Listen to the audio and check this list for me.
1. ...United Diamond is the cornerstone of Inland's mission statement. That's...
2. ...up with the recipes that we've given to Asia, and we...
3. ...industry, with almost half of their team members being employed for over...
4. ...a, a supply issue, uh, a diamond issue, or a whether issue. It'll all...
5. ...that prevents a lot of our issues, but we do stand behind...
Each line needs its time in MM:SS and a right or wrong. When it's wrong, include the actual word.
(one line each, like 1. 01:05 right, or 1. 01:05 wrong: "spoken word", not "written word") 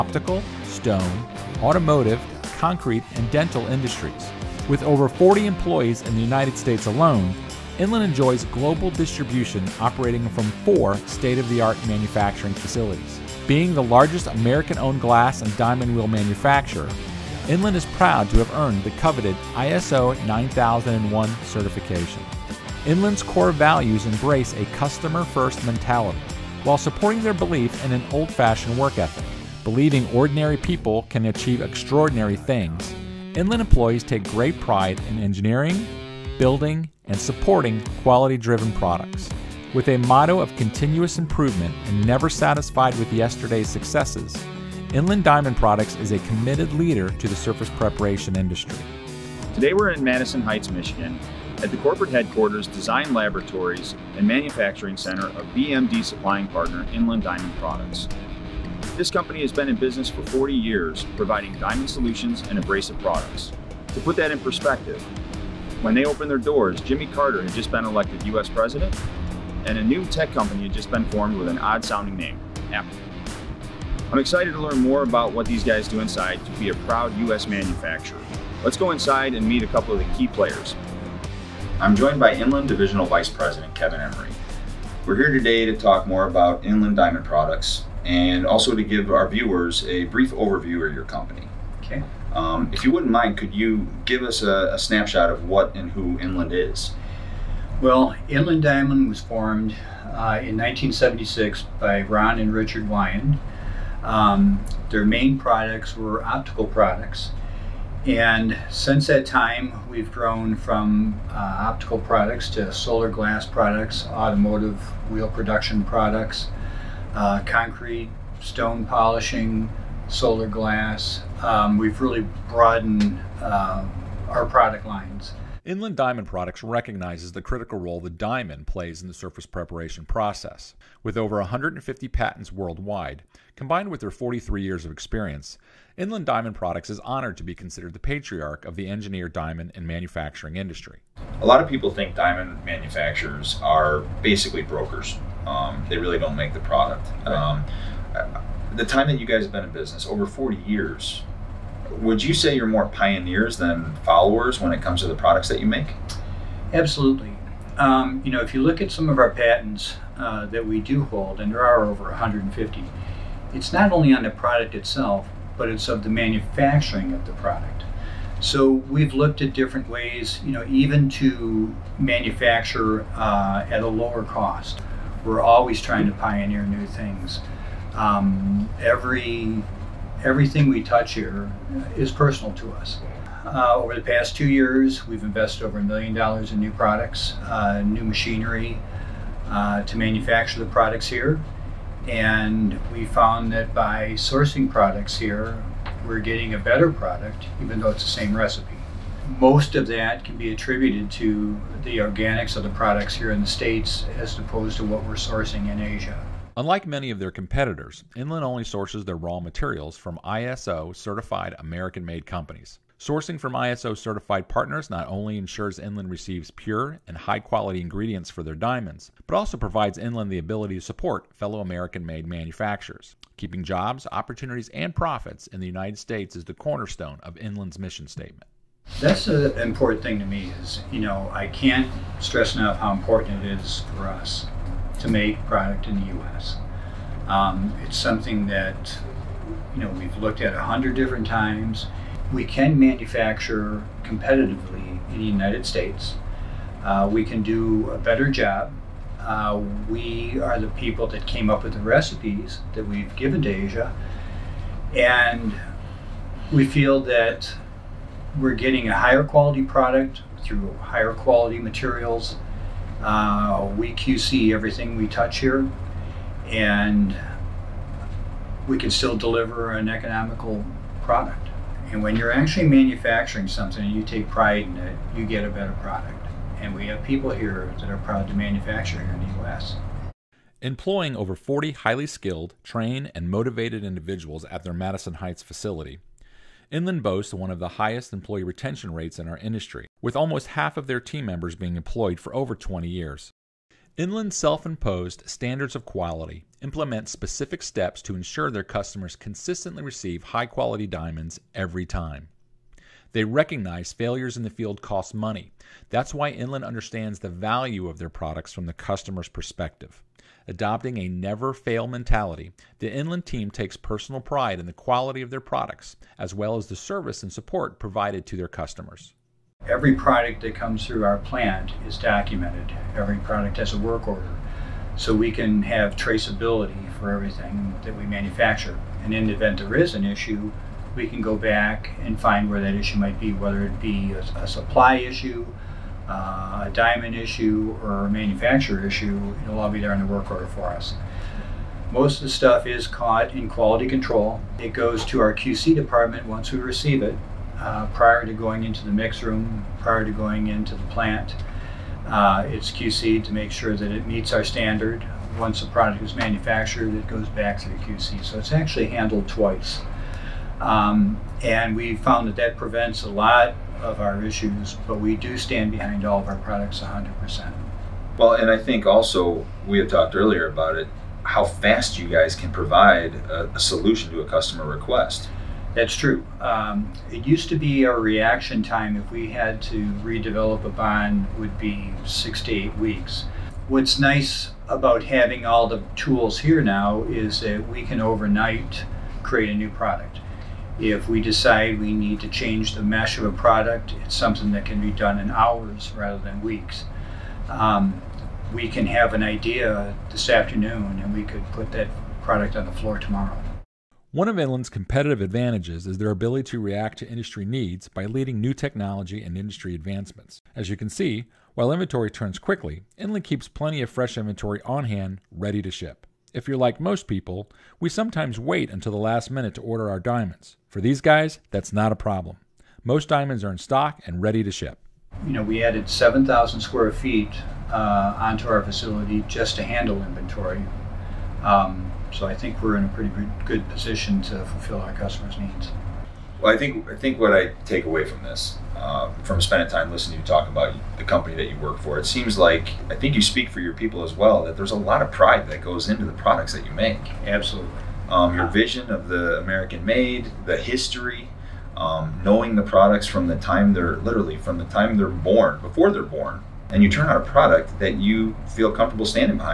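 1. 03:45 wrong: "States", not "Diamond"
2. 04:11 right
3. 04:49 right
4. 05:34 wrong: "manufacturer", not "whether"
5. 06:02 right.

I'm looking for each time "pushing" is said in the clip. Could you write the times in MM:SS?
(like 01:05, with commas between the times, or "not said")
not said.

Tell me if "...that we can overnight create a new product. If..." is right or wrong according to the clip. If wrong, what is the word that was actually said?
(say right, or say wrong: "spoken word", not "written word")
right.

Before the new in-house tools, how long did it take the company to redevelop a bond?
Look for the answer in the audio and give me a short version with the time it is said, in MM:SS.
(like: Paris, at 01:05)
6 to 8 weeks, at 06:22.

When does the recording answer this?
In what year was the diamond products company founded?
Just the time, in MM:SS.
01:40.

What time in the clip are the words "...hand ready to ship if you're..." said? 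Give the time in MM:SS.
06:54.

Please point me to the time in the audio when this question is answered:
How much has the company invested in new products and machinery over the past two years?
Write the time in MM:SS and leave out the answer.
03:05.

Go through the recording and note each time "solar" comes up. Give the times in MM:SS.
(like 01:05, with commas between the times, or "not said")
01:52, 02:00.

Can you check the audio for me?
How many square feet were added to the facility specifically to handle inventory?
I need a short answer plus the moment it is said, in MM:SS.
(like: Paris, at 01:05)
7,000, at 07:05.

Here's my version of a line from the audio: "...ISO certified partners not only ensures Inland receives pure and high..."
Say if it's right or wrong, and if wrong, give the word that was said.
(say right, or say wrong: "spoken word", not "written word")
right.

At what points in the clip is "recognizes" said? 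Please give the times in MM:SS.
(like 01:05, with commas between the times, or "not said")
02:06, 05:03.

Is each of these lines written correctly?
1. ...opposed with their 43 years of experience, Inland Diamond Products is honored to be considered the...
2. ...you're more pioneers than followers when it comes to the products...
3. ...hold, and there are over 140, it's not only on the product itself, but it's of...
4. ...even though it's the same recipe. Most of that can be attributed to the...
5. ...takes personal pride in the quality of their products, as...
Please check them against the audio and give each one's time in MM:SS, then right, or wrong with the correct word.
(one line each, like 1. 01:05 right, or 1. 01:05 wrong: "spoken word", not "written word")
1. 02:13 wrong: "combined", not "opposed"
2. 02:32 right
3. 02:41 wrong: "150", not "140"
4. 03:17 right
5. 05:13 right.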